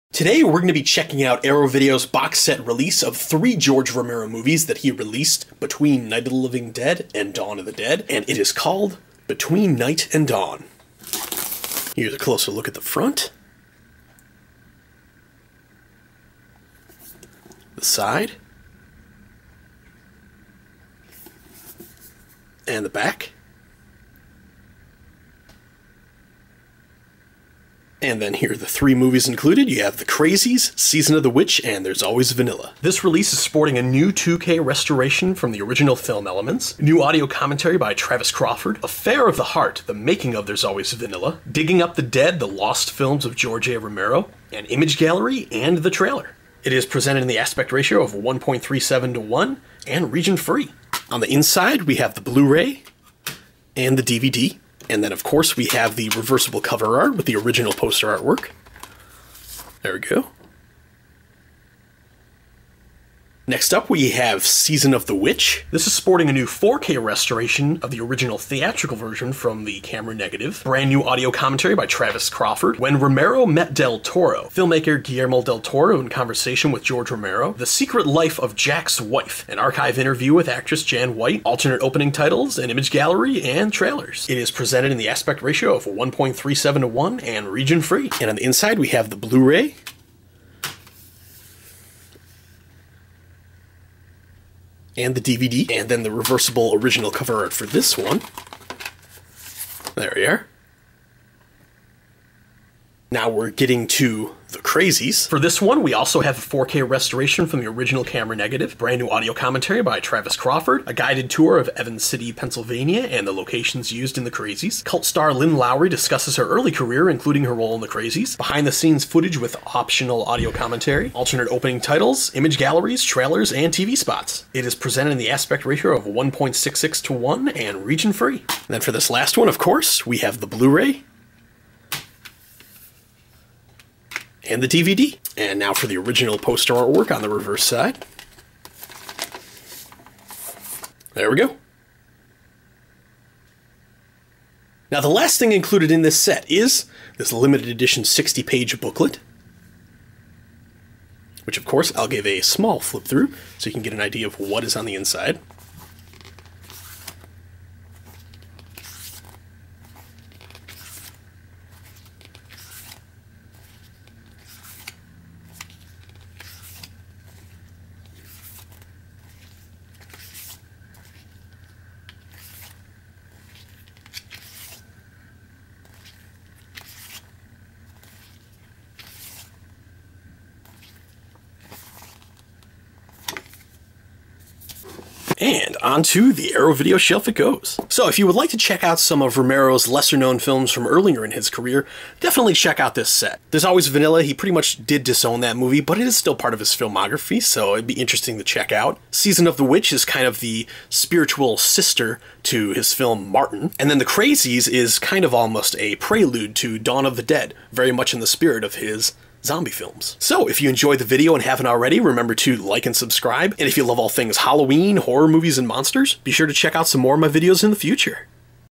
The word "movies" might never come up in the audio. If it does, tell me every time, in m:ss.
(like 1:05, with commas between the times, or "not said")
0:04, 0:28, 3:15, 3:35.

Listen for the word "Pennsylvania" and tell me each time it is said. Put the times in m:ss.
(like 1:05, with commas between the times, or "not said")
1:52.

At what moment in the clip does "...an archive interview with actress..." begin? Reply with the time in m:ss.
1:19.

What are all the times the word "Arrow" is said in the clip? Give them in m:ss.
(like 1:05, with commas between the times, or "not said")
0:01, 3:06.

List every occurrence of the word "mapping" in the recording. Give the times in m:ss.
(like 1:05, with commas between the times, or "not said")
not said.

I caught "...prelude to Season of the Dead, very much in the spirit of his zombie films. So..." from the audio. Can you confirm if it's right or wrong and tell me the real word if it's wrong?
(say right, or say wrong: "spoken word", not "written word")
wrong: "Dawn", not "Season".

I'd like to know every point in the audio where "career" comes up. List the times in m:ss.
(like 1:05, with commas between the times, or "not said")
1:56, 3:11.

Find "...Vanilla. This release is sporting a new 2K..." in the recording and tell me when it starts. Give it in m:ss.
0:32.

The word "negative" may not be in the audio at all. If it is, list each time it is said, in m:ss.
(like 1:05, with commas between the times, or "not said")
1:10, 1:48.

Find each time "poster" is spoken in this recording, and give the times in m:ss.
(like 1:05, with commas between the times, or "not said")
0:57, 2:16.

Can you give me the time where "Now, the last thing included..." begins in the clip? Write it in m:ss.
2:24.